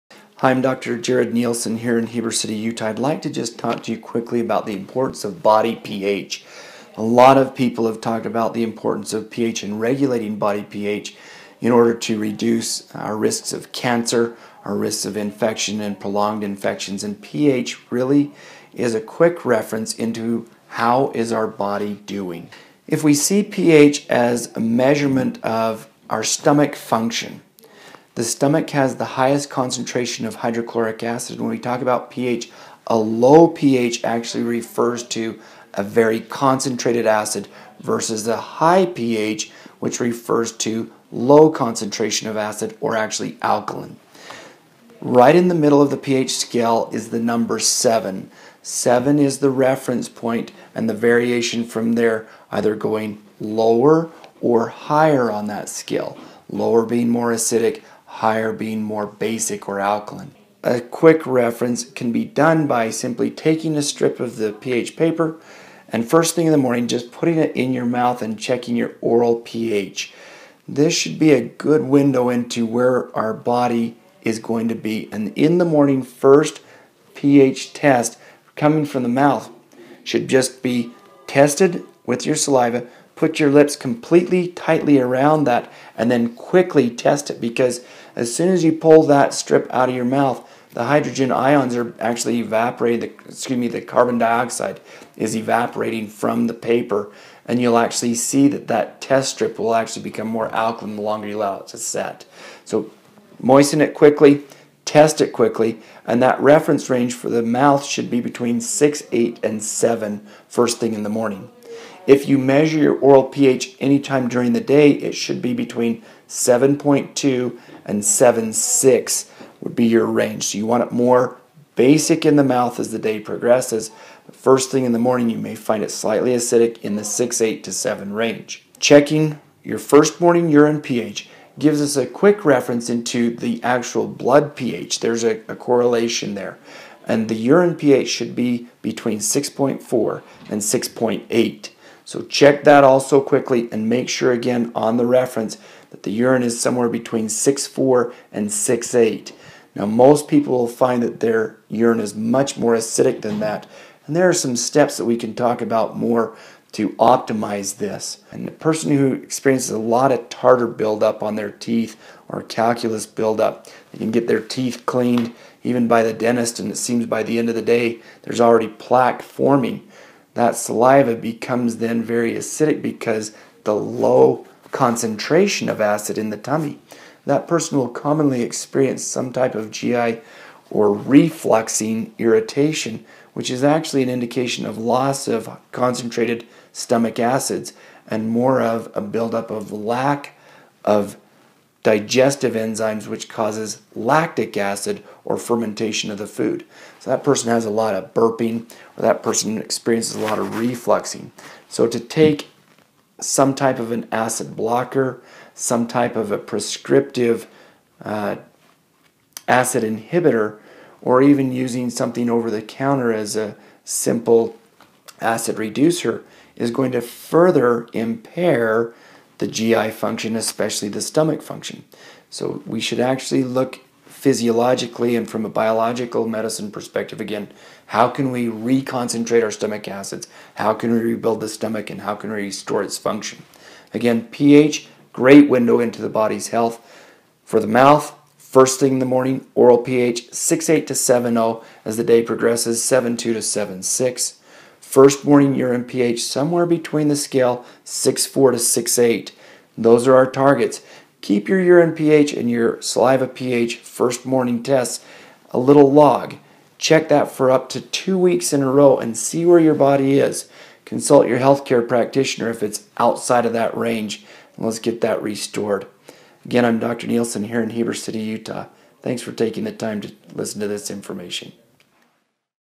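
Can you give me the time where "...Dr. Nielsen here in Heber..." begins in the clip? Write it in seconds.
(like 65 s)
266 s.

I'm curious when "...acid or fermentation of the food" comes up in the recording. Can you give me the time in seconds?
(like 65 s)
194 s.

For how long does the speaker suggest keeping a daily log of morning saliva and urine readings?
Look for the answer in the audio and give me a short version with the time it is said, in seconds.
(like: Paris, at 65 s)
2 weeks, at 257 s.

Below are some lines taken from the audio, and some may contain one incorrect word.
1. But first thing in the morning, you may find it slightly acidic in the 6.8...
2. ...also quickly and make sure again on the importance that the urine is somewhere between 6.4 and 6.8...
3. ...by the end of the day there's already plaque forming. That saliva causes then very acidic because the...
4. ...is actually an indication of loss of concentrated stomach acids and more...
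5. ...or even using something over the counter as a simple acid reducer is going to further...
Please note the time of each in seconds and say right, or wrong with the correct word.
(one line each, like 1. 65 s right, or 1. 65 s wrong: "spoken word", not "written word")
1. 124 s right
2. 142 s wrong: "reference", not "importance"
3. 167 s wrong: "becomes", not "causes"
4. 183 s right
5. 211 s right.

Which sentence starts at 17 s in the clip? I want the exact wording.
And pH really is a quick reference into how is our body doing.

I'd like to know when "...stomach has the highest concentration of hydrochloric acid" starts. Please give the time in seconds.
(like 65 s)
28 s.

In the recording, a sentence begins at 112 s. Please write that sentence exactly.
If you measure your oral pH anytime during the day, it should be between 7.2 and 7.6 would be your range.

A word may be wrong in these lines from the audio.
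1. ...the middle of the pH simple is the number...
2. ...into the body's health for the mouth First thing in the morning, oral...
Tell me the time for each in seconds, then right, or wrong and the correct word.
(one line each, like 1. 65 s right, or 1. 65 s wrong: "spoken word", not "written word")
1. 45 s wrong: "scale", not "simple"
2. 235 s right.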